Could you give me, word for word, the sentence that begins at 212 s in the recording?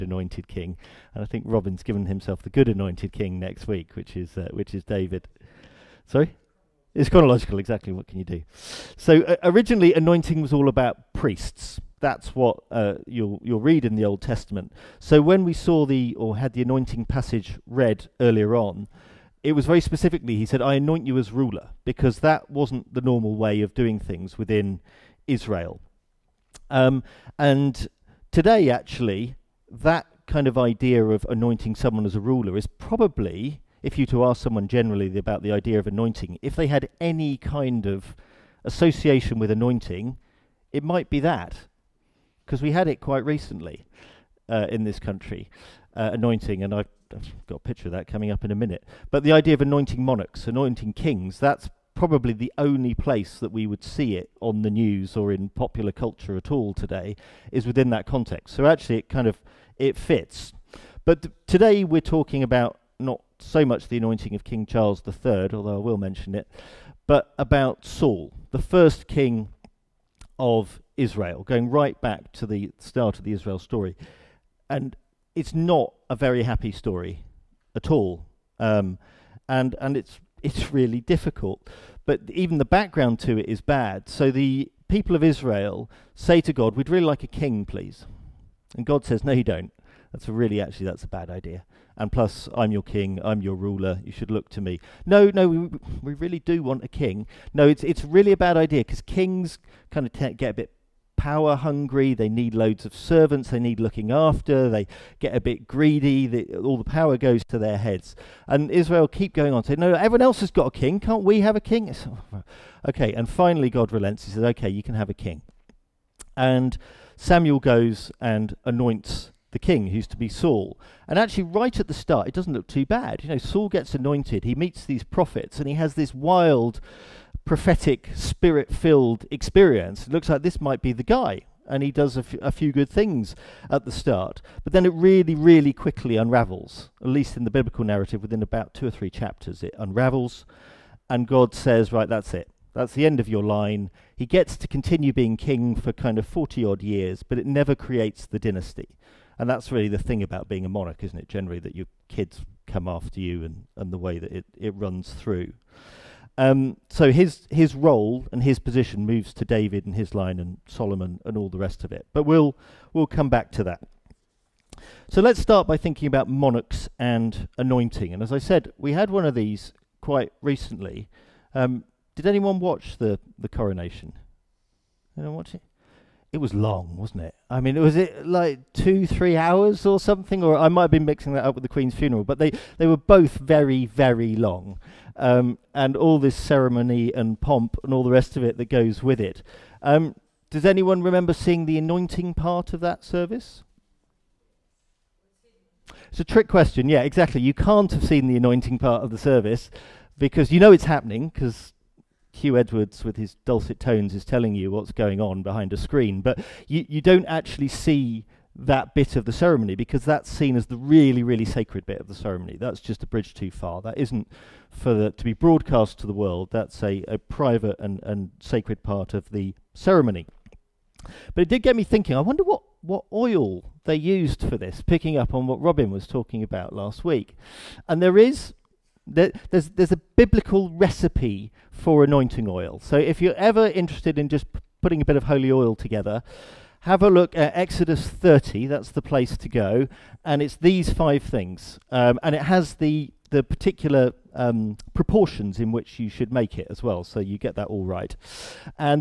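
That's just a bridge too far.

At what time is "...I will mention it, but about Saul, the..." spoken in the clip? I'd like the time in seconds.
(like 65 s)
65 s.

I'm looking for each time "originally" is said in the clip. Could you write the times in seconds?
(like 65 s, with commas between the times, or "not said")
9 s.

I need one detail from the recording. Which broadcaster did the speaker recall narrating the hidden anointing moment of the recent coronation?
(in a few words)
Huw Edwards.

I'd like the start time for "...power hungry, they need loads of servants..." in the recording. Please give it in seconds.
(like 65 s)
101 s.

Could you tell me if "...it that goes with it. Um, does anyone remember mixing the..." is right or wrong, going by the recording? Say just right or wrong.
wrong.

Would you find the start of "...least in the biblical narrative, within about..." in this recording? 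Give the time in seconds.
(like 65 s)
137 s.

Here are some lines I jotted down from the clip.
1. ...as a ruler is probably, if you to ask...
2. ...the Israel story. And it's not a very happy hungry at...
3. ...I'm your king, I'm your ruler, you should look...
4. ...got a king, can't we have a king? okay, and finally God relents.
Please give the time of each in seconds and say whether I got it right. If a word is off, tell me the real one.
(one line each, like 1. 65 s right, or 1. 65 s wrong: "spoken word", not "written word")
1. 32 s right
2. 73 s wrong: "story", not "hungry"
3. 92 s right
4. 110 s right.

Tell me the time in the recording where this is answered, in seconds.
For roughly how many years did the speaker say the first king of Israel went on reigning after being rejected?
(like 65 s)
146 s.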